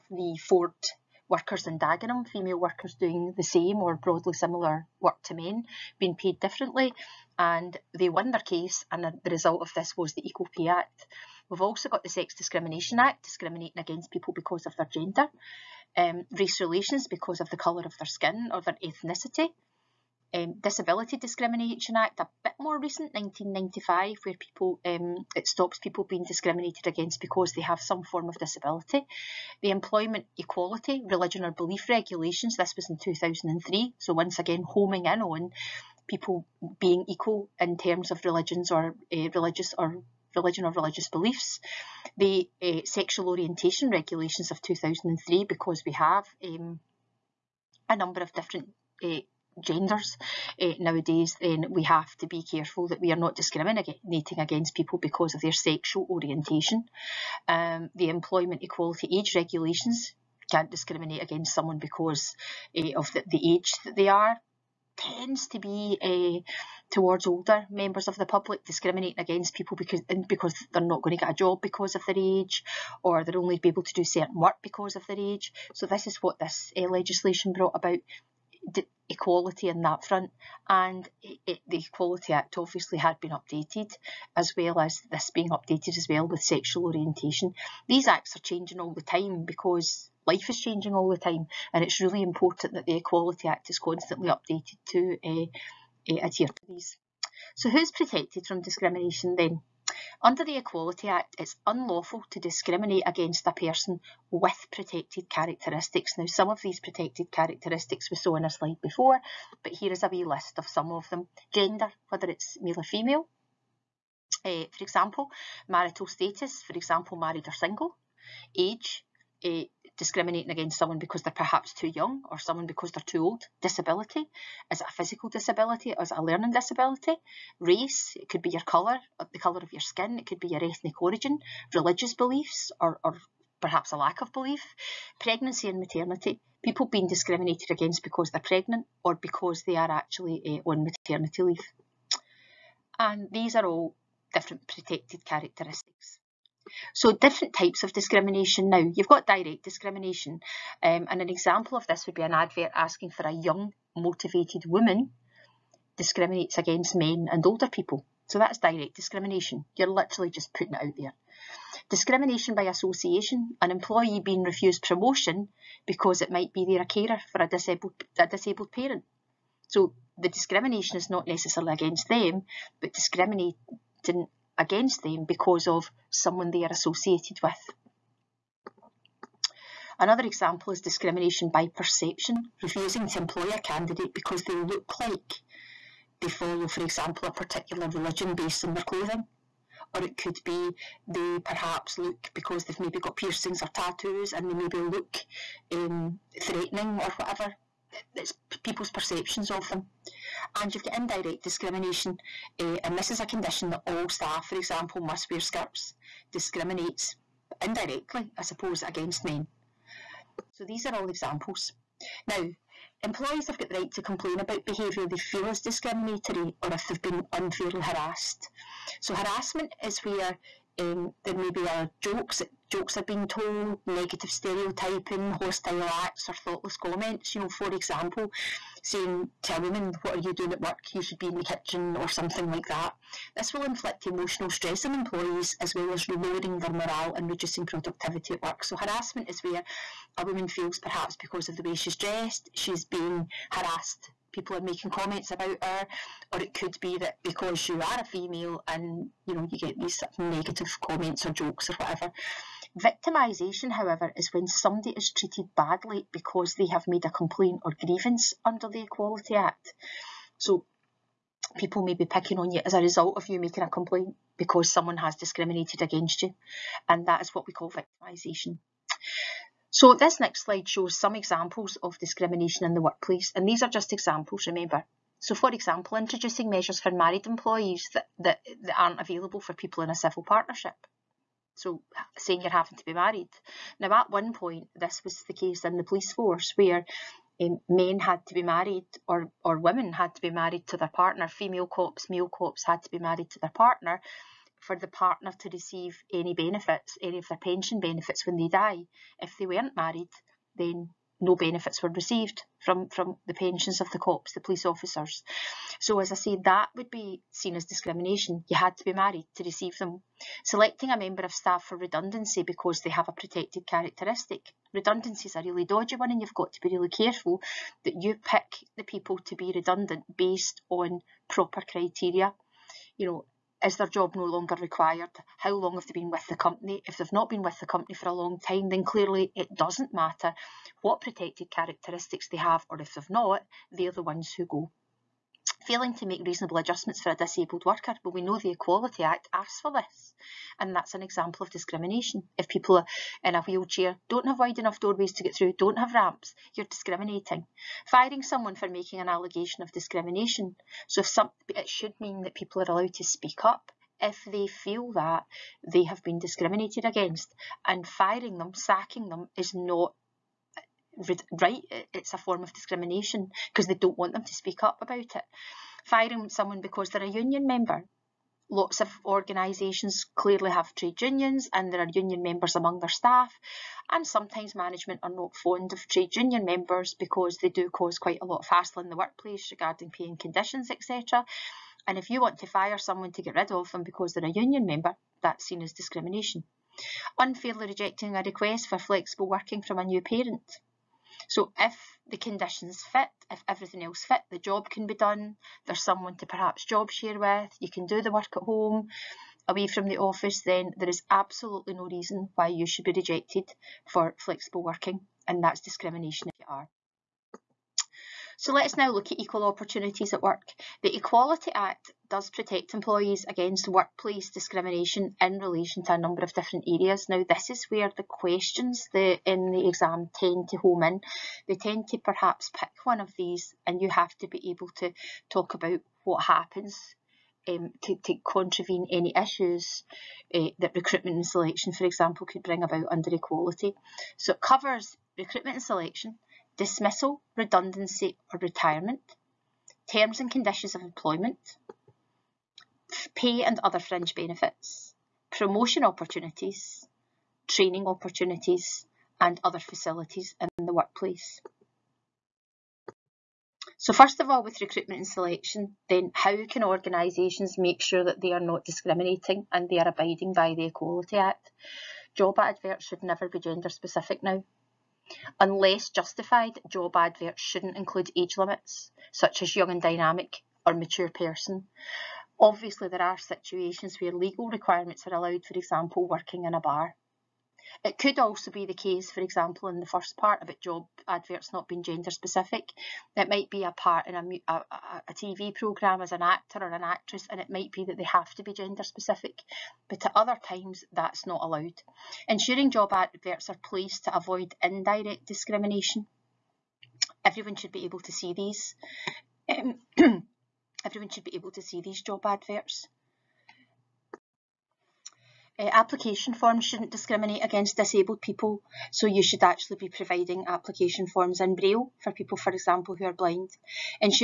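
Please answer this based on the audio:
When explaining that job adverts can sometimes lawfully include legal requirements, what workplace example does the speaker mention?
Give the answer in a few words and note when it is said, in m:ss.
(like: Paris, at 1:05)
Working in a bar, at 7:56.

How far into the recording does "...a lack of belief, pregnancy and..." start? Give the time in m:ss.
2:13.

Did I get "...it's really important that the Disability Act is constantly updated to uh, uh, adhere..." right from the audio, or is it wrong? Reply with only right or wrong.
wrong.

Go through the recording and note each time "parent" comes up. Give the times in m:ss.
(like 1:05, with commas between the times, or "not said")
2:48, 6:29.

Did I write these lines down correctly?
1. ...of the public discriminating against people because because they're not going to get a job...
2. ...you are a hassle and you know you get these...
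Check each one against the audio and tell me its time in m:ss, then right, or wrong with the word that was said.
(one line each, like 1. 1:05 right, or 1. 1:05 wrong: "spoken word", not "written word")
1. 1:08 right
2. 4:07 wrong: "female", not "hassle".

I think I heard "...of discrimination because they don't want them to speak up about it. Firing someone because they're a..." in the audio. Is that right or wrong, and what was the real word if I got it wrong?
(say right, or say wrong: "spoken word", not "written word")
right.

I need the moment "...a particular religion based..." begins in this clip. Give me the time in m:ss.
3:07.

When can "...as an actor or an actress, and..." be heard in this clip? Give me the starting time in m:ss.
8:06.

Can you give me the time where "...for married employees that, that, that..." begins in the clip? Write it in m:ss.
4:36.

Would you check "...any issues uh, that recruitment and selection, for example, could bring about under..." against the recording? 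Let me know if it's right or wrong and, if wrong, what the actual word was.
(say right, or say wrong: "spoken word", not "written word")
right.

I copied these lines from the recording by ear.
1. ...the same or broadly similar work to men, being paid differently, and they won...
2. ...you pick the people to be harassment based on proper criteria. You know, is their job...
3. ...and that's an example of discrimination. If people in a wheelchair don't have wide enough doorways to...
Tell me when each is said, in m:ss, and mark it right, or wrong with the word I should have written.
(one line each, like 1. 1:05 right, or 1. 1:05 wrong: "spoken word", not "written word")
1. 0:03 right
2. 5:18 wrong: "redundant", not "harassment"
3. 5:40 right.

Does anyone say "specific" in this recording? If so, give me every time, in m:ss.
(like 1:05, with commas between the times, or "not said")
7:43, 8:02, 8:08.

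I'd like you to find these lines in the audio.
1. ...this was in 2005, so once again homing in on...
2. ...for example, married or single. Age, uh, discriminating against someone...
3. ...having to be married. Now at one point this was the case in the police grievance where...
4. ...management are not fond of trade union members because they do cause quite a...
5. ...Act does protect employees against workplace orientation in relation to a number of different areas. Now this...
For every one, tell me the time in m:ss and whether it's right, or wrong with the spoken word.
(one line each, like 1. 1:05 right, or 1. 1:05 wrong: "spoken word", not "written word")
1. 0:32 wrong: "2003", not "2005"
2. 1:56 right
3. 4:42 wrong: "force", not "grievance"
4. 6:14 right
5. 6:51 wrong: "discrimination", not "orientation".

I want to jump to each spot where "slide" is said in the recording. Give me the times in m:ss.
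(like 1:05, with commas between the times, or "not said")
1:48, 4:30.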